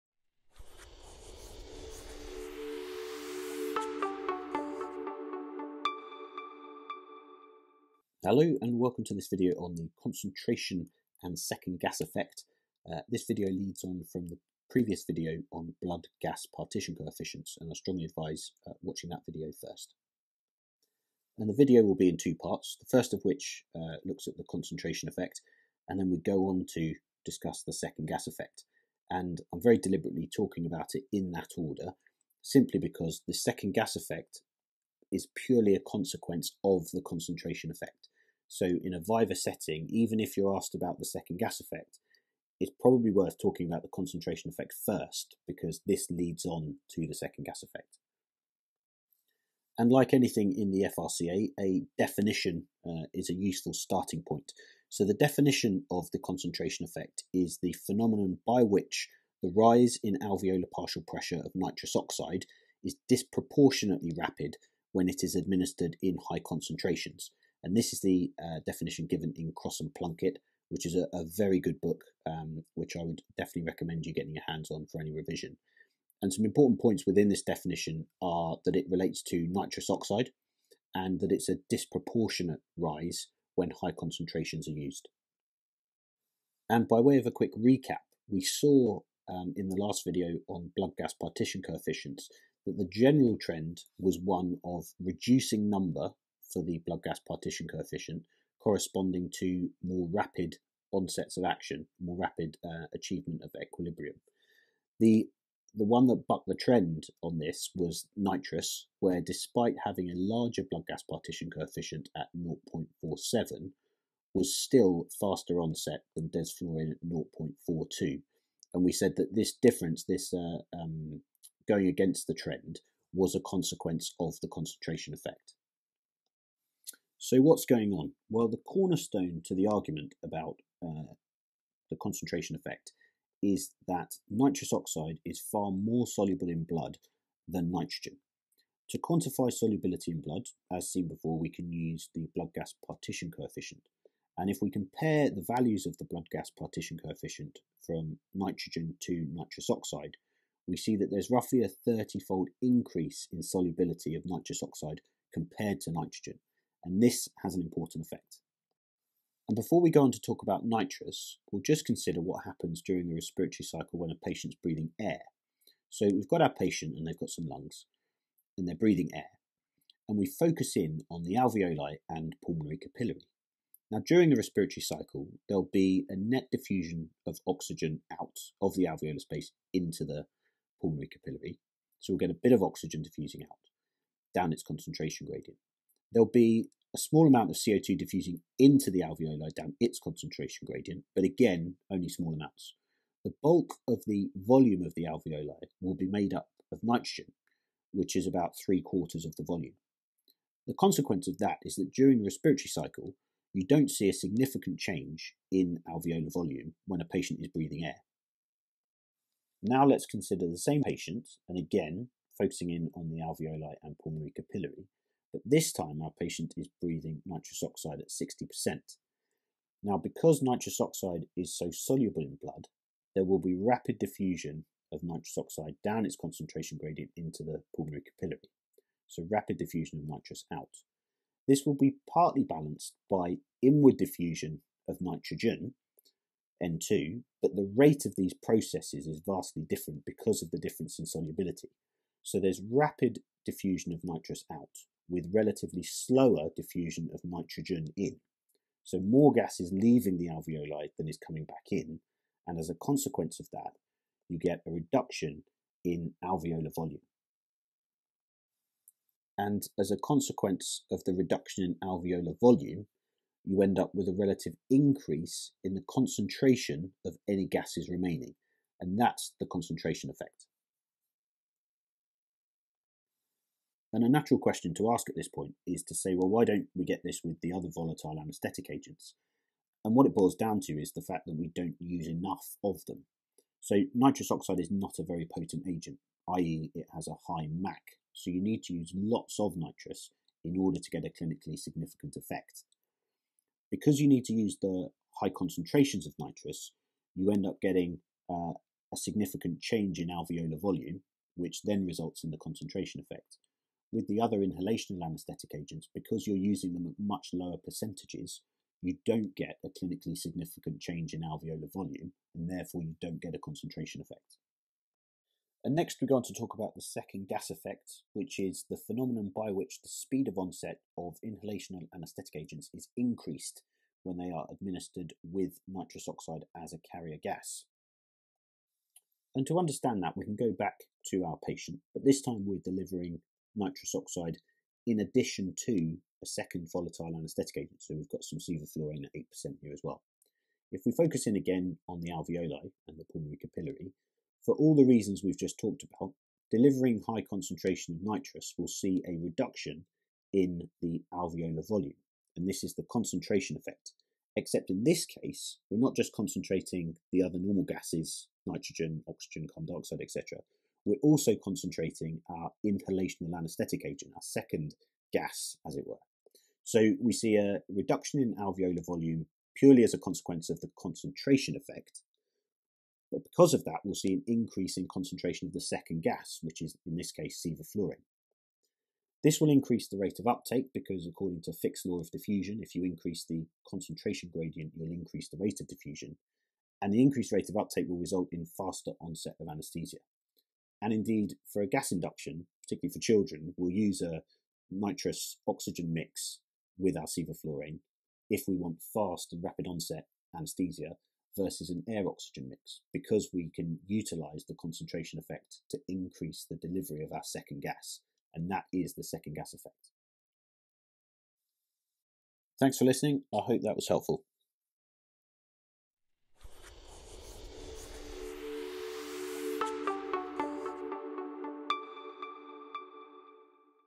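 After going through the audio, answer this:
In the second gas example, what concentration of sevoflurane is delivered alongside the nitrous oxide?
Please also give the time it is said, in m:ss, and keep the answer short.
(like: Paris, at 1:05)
8%, at 5:39.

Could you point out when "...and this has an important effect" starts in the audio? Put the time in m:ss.
2:36.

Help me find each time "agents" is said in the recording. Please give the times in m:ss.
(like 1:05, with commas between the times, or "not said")
4:38, 4:45, 5:05, 5:22, 5:37, 6:03.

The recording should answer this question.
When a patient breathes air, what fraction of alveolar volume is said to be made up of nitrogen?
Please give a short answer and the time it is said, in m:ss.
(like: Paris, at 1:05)
Three quarters, at 3:18.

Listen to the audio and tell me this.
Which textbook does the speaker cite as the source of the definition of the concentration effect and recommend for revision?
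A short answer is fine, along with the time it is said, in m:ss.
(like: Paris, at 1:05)
Cross and Plunkett, at 1:09.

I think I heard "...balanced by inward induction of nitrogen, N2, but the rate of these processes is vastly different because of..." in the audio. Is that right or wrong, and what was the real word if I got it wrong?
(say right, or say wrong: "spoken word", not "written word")
wrong: "diffusion", not "induction".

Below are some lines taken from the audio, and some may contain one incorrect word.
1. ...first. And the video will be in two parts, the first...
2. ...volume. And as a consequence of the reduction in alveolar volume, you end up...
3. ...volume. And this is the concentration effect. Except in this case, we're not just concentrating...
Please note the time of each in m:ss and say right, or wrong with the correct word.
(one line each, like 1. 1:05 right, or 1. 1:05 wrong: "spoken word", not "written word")
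1. 0:19 right
2. 4:16 right
3. 5:51 right.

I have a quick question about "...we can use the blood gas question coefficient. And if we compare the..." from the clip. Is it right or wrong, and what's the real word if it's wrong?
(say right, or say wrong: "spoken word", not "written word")
wrong: "partition", not "question".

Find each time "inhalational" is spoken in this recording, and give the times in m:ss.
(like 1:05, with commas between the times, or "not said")
5:04, 5:21, 6:02.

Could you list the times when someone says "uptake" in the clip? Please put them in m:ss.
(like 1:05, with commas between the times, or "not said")
6:20, 6:27.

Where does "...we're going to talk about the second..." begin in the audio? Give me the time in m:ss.
5:16.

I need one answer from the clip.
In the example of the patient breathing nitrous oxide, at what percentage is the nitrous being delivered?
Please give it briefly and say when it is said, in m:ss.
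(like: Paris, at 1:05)
60%, at 3:38.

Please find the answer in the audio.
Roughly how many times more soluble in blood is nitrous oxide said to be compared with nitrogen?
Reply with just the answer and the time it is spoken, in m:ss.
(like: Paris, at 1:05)
30 fold, at 2:31.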